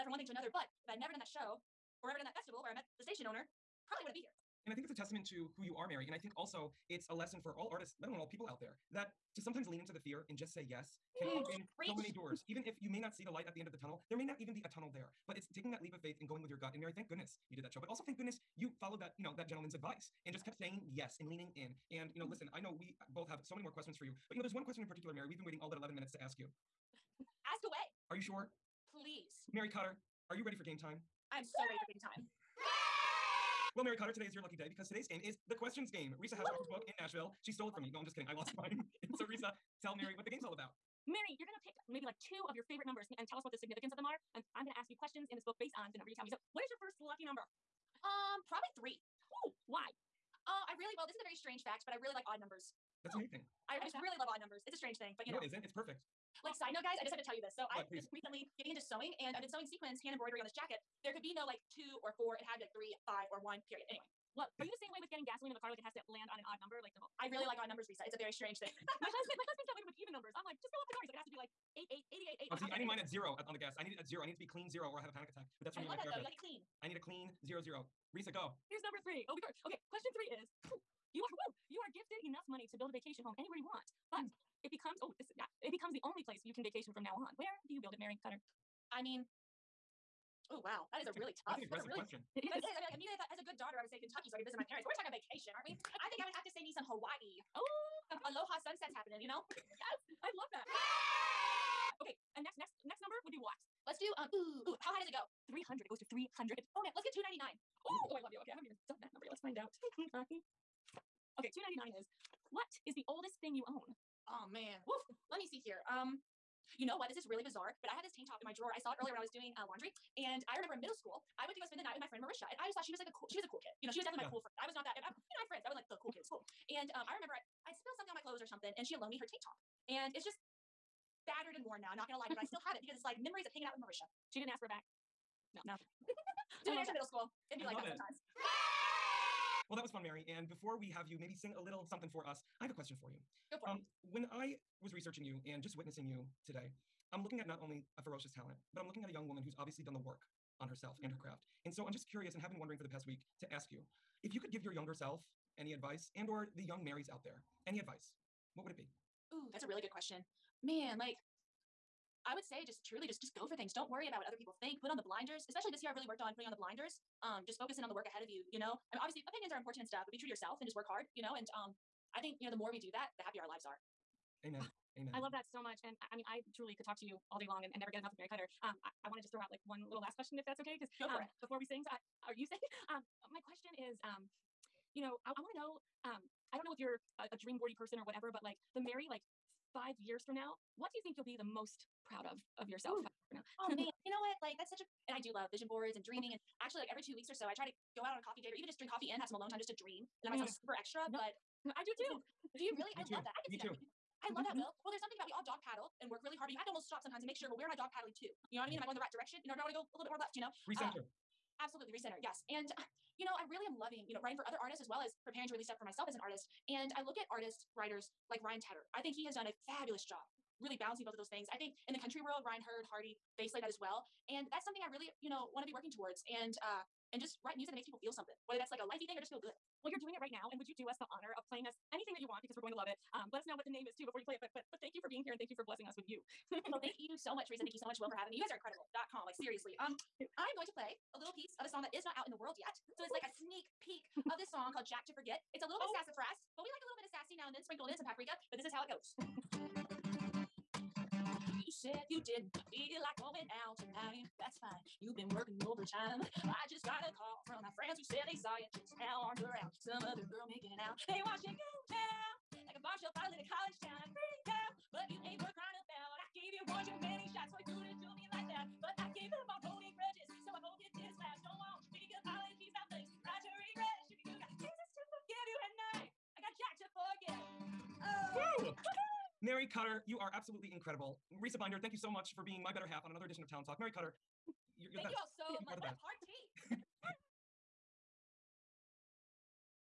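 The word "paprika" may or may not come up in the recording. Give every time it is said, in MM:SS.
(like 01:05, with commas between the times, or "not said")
04:08.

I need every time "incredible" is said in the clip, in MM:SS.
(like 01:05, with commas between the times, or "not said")
03:58, 04:40.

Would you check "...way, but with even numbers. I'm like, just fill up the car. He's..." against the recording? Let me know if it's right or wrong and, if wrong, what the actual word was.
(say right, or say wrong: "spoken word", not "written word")
right.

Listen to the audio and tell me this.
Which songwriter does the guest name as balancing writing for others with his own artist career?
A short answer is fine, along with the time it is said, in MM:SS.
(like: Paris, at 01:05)
Ryan Tedder, at 03:38.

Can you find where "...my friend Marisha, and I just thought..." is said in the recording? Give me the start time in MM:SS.
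02:02.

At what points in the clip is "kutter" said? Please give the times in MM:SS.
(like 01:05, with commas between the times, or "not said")
00:29, 00:33, 01:28, 02:58, 04:39, 04:43.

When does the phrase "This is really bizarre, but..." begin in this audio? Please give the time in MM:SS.
01:57.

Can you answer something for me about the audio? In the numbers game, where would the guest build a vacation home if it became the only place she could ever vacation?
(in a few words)
Hawaii.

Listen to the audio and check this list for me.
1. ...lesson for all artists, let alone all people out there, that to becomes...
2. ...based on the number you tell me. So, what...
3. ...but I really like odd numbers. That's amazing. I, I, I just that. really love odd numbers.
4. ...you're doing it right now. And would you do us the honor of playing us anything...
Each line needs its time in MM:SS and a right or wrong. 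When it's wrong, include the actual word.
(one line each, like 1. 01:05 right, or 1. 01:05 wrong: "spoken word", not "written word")
1. 00:07 wrong: "sometimes", not "becomes"
2. 00:45 right
3. 00:51 right
4. 03:49 right.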